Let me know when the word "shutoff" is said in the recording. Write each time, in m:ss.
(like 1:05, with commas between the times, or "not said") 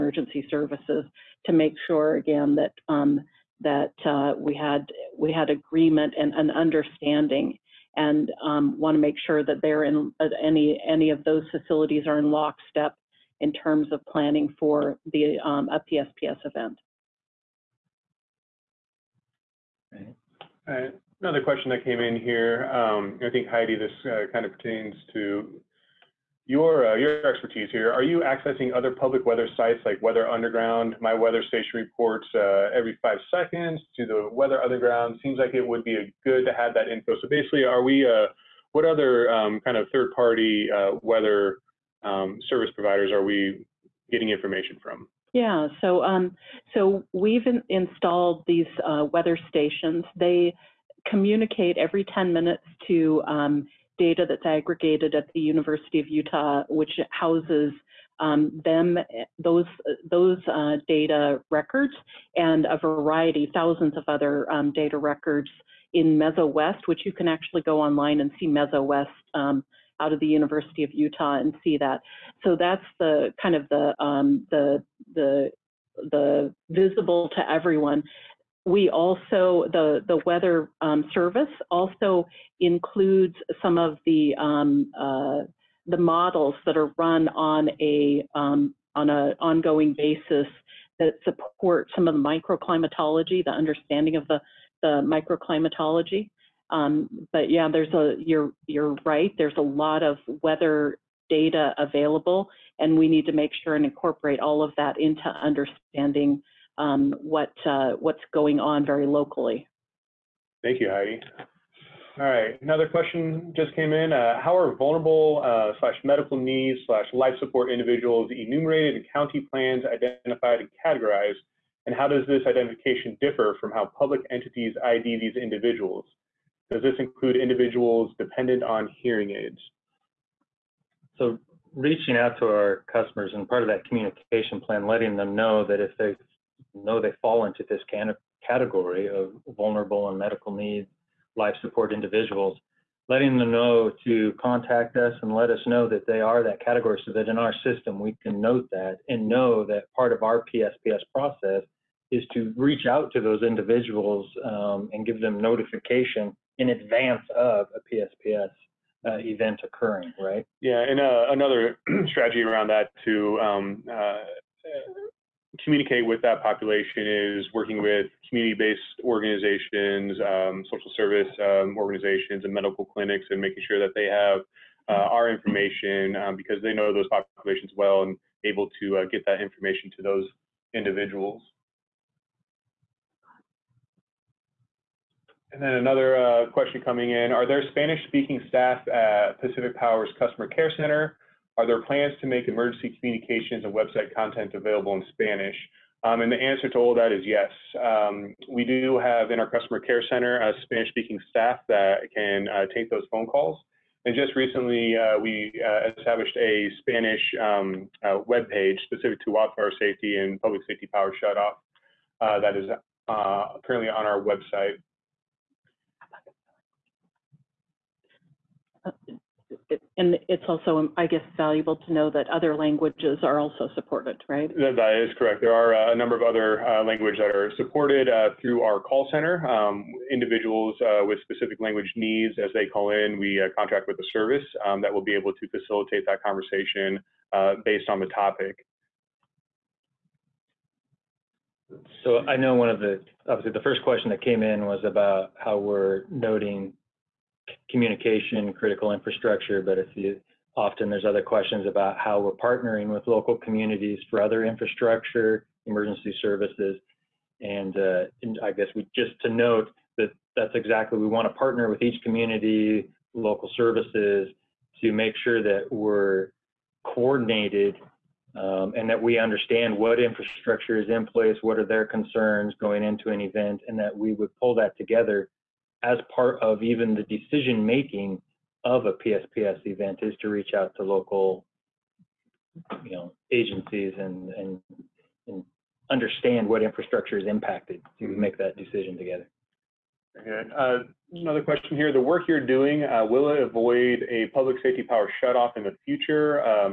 3:31, 4:55.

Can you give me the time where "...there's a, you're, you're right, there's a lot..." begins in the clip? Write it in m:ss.
1:37.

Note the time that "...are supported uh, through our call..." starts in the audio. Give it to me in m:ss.
3:47.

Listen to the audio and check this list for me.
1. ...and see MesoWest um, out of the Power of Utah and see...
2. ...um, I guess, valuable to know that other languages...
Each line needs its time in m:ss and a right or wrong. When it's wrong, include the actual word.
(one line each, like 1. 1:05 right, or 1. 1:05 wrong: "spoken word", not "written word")
1. 1:08 wrong: "University", not "Power"
2. 3:40 right.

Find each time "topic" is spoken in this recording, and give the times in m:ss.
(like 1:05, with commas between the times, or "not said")
3:58.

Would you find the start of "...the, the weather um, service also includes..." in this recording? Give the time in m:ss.
1:19.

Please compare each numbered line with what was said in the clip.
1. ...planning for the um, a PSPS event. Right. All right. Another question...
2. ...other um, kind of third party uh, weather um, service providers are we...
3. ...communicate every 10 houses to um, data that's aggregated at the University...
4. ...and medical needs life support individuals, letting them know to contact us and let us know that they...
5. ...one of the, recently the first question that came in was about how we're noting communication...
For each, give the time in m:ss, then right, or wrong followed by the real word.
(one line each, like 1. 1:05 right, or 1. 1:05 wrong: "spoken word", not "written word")
1. 0:14 right
2. 0:38 right
3. 0:51 wrong: "minutes", not "houses"
4. 2:20 right
5. 4:02 wrong: "obviously", not "recently".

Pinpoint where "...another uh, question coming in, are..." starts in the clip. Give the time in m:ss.
3:05.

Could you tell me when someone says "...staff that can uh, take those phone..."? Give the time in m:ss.
3:21.